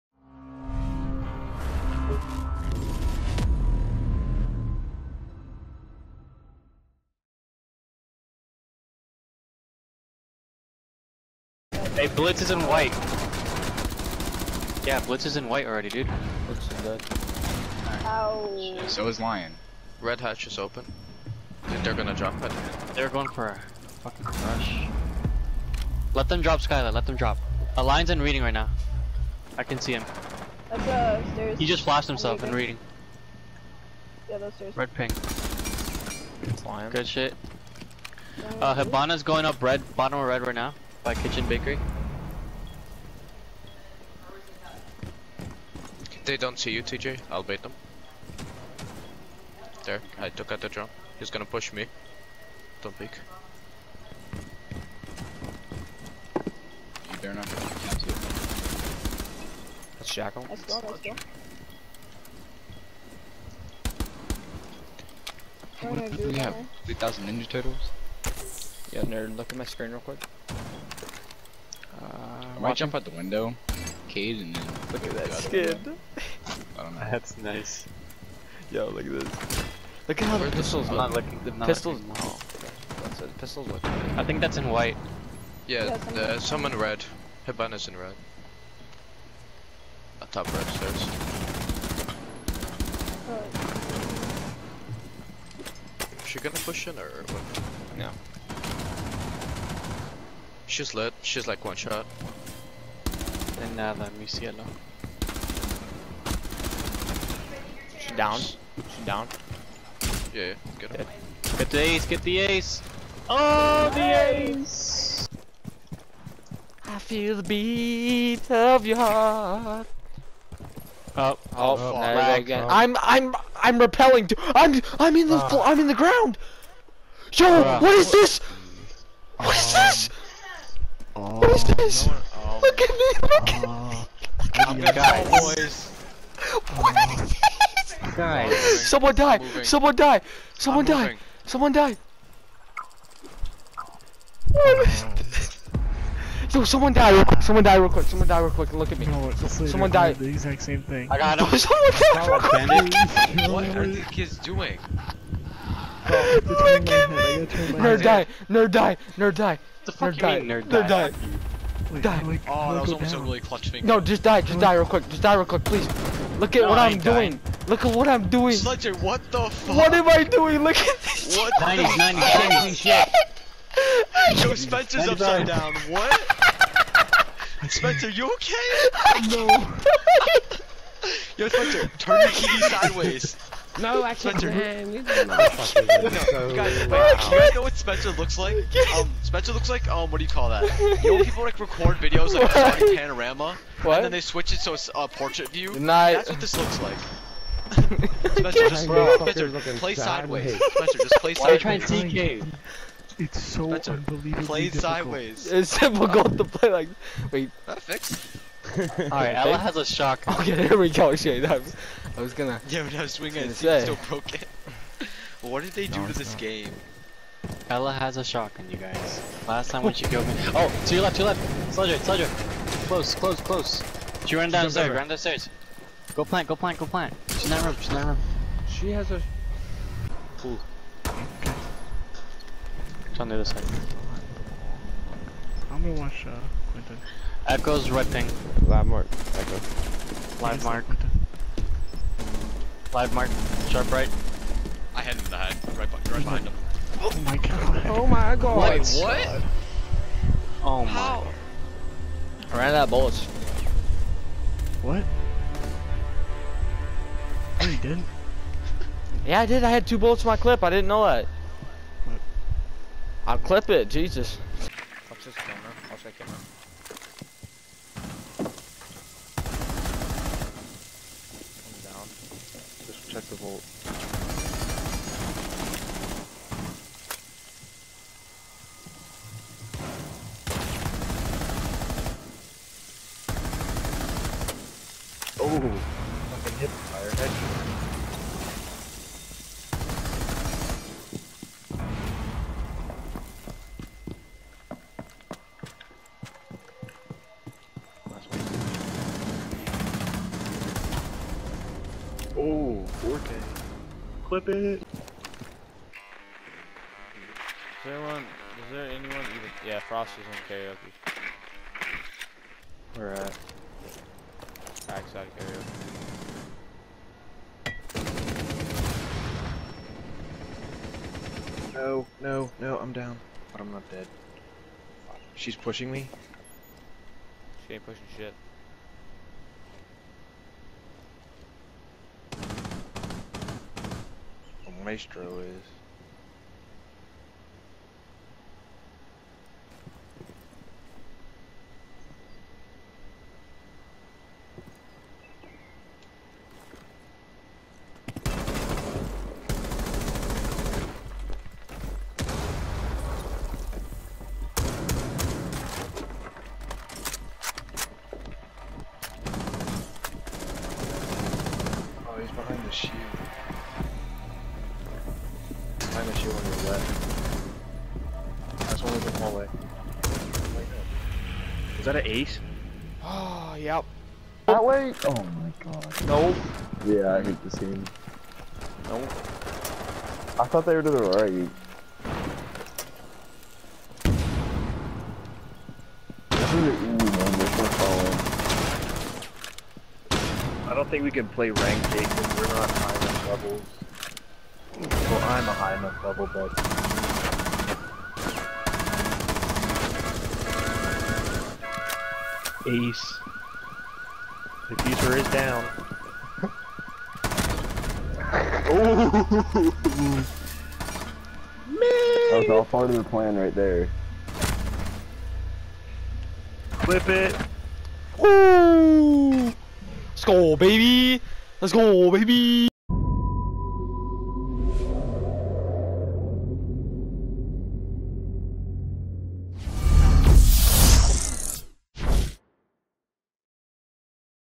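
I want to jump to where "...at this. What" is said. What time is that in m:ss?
2:50.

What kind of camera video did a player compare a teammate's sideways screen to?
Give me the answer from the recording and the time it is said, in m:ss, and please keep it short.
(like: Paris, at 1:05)
Panorama, at 3:12.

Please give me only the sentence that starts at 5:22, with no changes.
I'm down, but I'm not dead.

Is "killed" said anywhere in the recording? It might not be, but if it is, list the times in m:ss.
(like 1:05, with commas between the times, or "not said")
3:40.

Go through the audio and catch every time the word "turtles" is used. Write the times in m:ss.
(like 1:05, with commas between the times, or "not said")
1:07.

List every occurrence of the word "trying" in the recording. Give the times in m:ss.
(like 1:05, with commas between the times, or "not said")
3:21.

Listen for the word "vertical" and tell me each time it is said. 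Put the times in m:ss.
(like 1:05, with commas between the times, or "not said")
not said.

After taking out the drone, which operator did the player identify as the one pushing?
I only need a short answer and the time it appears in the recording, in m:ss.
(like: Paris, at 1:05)
Jackal, at 1:00.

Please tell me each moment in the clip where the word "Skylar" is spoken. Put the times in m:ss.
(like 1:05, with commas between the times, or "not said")
0:26.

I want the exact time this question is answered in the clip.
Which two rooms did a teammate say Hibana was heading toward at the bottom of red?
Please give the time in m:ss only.
0:41.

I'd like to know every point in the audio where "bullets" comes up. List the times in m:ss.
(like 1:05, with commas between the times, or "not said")
4:12, 4:19.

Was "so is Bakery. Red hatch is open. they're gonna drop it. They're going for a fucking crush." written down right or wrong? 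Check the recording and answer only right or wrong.
wrong.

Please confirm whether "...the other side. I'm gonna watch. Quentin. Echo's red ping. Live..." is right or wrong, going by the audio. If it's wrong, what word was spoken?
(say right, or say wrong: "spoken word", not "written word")
right.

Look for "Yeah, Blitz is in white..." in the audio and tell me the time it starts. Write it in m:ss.
0:14.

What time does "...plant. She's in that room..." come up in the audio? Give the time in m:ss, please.
3:46.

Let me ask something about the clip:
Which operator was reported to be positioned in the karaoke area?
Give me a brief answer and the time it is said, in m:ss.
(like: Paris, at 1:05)
Frost, at 5:09.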